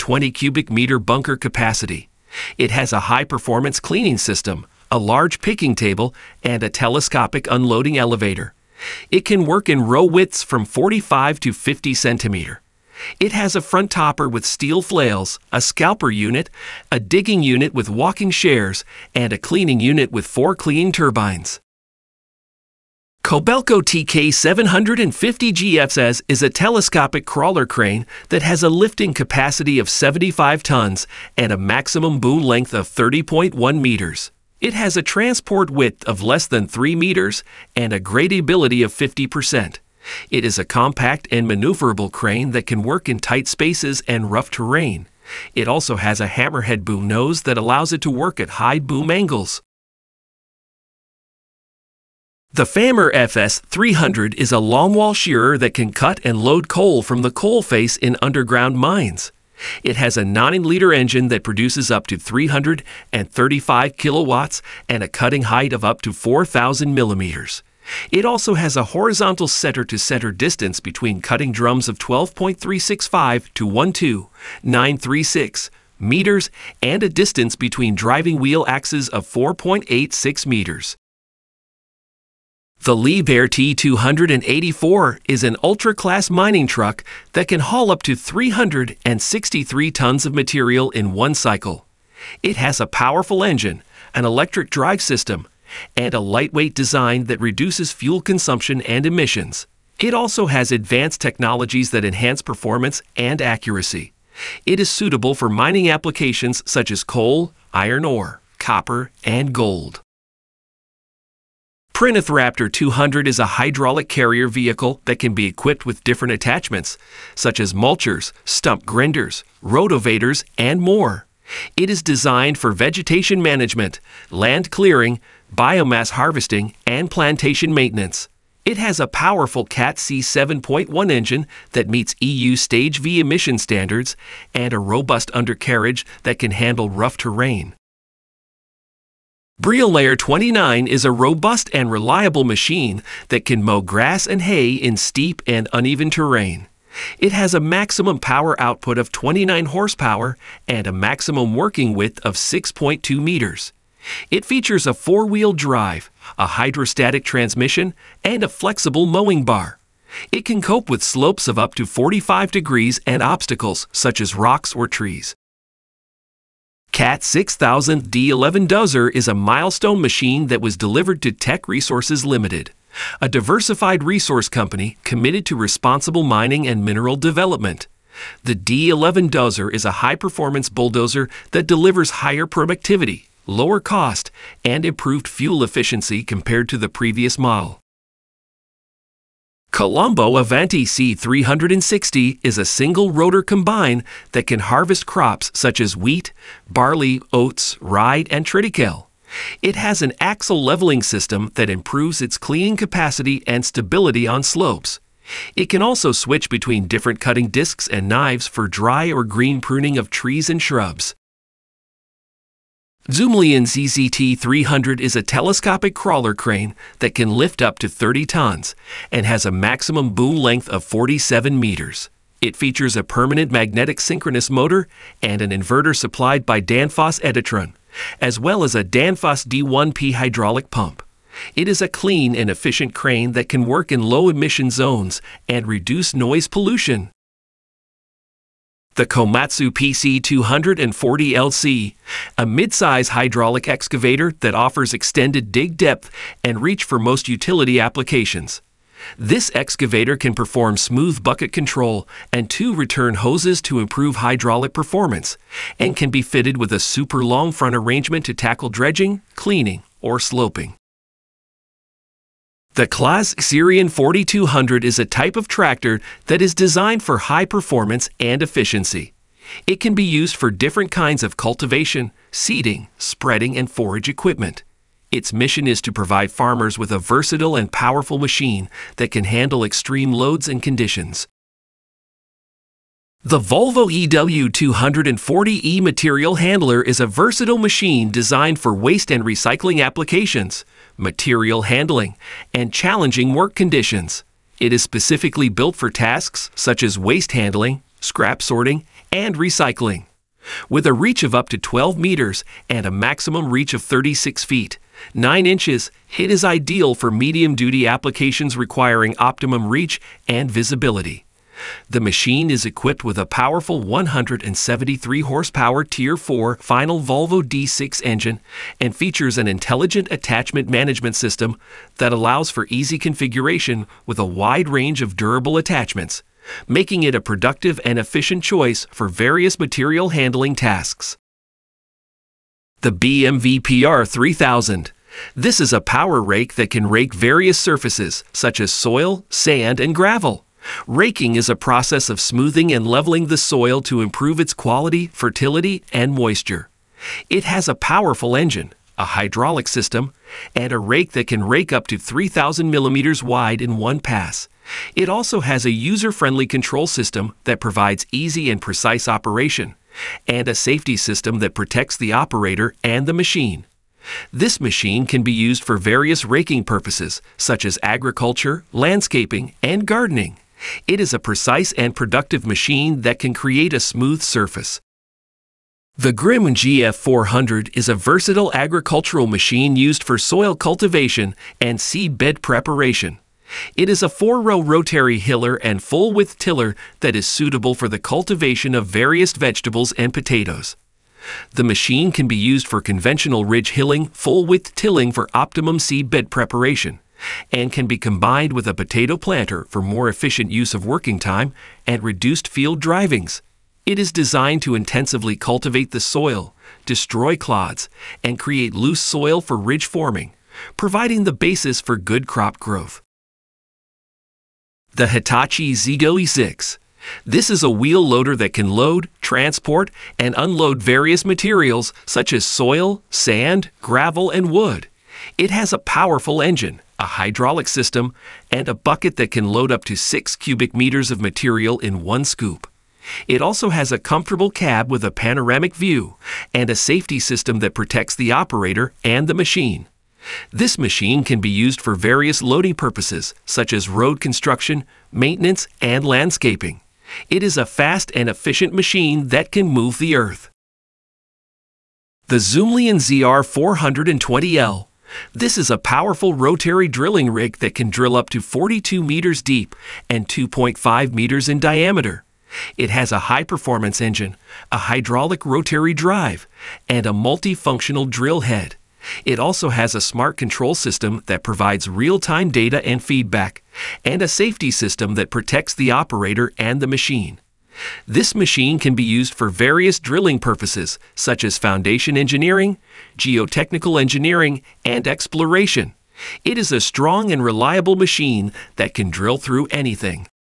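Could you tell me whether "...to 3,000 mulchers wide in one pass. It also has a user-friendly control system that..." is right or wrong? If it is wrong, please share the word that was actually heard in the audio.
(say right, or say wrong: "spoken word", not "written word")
wrong: "millimeters", not "mulchers".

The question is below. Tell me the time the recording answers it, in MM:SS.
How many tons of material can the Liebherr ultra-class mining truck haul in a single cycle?
01:28.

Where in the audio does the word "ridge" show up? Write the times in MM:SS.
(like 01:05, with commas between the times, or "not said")
06:33, 06:49.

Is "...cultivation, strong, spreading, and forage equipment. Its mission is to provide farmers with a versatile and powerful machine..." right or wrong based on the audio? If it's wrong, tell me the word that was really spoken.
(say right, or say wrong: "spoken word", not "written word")
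wrong: "seeding", not "strong".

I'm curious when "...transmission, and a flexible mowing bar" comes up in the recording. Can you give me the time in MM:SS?
02:37.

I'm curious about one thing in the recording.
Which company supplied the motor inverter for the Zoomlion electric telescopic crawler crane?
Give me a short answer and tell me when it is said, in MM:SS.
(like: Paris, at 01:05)
Danfoss Editron, at 03:46.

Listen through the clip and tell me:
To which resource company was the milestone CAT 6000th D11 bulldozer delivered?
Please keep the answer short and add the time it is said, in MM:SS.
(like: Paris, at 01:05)
Teck Resources Limited, at 02:51.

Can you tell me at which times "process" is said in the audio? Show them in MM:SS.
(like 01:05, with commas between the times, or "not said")
05:41.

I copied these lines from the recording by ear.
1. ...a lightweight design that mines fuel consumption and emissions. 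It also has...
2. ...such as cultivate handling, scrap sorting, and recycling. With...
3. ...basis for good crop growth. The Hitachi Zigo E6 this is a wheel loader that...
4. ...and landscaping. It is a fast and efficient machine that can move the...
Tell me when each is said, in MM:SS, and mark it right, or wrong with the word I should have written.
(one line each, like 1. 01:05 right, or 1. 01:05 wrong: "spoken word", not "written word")
1. 01:36 wrong: "reduces", not "mines"
2. 04:56 wrong: "waste", not "cultivate"
3. 06:51 right
4. 07:25 right.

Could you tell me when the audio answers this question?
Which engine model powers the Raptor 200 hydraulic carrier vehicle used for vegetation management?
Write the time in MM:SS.
02:09.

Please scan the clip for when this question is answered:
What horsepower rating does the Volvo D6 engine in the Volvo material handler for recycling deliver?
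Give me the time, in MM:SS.
05:13.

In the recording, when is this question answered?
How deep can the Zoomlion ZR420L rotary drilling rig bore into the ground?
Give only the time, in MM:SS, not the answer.
07:38.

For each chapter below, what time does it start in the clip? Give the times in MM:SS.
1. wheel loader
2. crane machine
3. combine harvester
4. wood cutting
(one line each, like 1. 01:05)
1. 07:01
2. 03:59
3. 02:59
4. 02:43.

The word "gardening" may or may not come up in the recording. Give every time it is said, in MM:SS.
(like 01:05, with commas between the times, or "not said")
06:09.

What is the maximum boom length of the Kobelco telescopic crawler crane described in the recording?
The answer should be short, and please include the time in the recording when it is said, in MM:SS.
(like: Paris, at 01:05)
30.1 meters, at 00:32.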